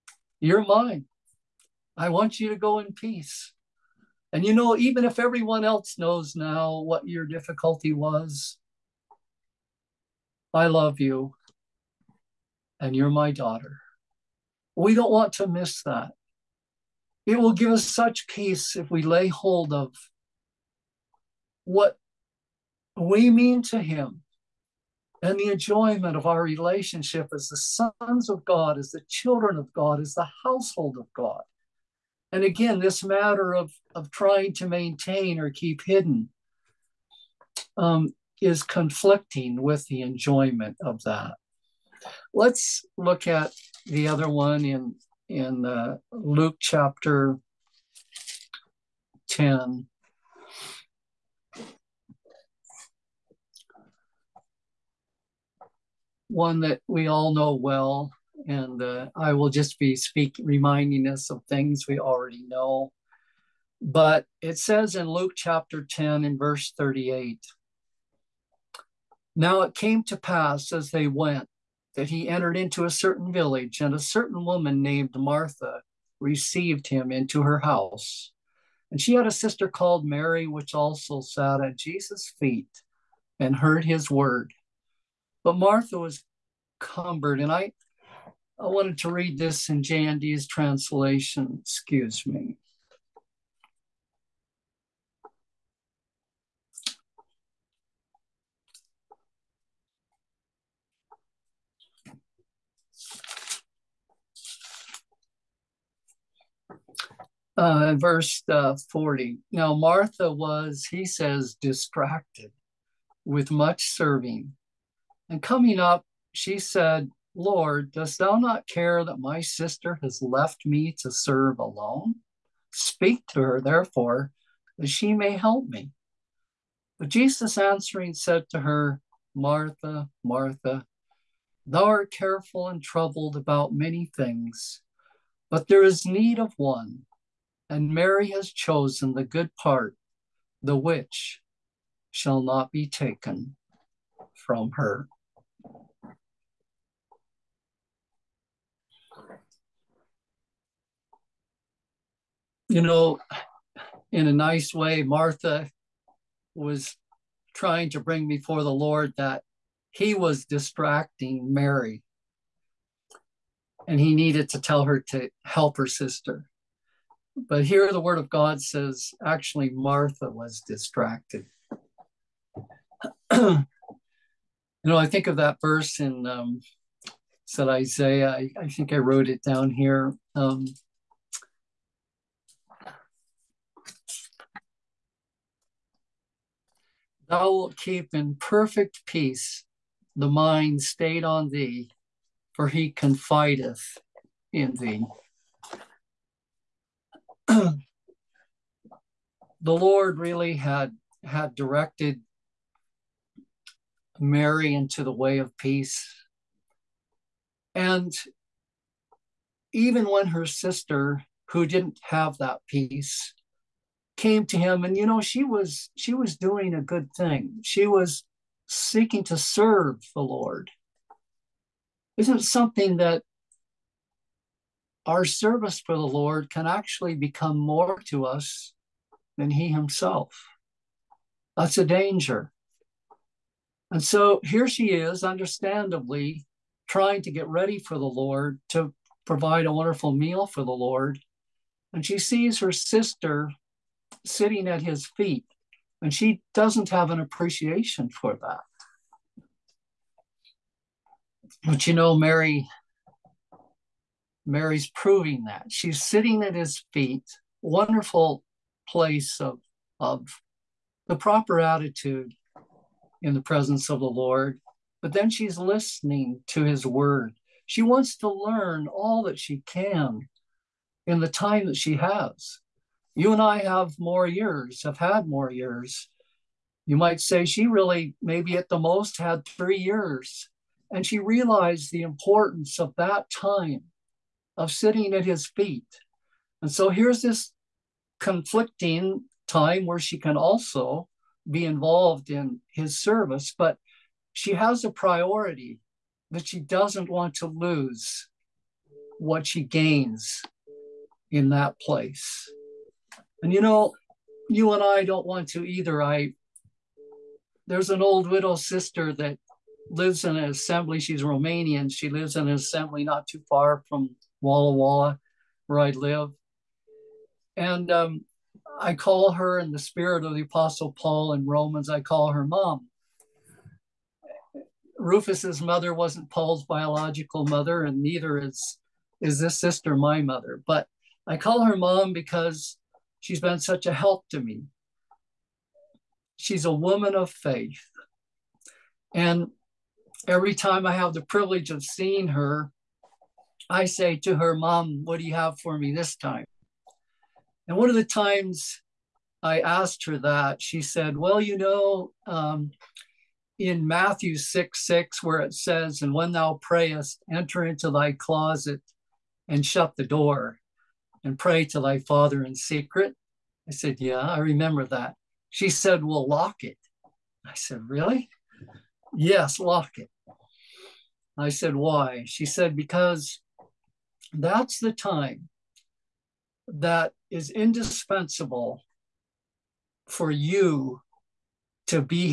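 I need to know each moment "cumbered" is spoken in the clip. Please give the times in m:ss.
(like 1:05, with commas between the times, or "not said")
1:26.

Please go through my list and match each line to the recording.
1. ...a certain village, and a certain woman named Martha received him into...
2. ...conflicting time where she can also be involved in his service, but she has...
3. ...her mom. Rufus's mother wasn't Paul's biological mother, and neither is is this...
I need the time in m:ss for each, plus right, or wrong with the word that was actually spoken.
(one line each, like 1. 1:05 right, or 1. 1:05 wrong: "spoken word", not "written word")
1. 1:12 right
2. 4:48 right
3. 5:22 right.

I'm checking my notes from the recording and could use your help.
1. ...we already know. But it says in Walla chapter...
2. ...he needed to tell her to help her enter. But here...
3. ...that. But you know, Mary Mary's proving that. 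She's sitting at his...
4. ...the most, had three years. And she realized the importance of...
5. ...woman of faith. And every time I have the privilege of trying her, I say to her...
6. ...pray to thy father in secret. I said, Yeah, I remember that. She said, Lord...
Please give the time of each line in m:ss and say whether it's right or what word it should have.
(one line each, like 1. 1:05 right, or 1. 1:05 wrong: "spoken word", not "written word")
1. 1:01 wrong: "Luke", not "Walla"
2. 2:43 wrong: "sister", not "enter"
3. 4:08 right
4. 4:38 right
5. 5:36 wrong: "seeing", not "trying"
6. 6:01 wrong: "Well", not "Lord".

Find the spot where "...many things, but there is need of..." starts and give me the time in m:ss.
2:13.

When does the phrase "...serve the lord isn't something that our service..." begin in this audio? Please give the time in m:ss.
3:39.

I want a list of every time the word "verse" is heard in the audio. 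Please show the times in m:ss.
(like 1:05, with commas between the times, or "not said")
1:06, 1:47, 2:55.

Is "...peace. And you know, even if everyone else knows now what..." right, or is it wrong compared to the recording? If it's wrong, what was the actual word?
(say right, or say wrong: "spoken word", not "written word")
right.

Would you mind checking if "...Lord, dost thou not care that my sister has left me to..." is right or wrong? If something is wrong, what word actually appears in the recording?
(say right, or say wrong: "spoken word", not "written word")
right.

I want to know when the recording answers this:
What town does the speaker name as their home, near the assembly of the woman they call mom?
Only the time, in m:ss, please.
5:14.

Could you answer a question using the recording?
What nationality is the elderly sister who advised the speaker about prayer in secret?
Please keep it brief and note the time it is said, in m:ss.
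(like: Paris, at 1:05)
Romanian, at 5:11.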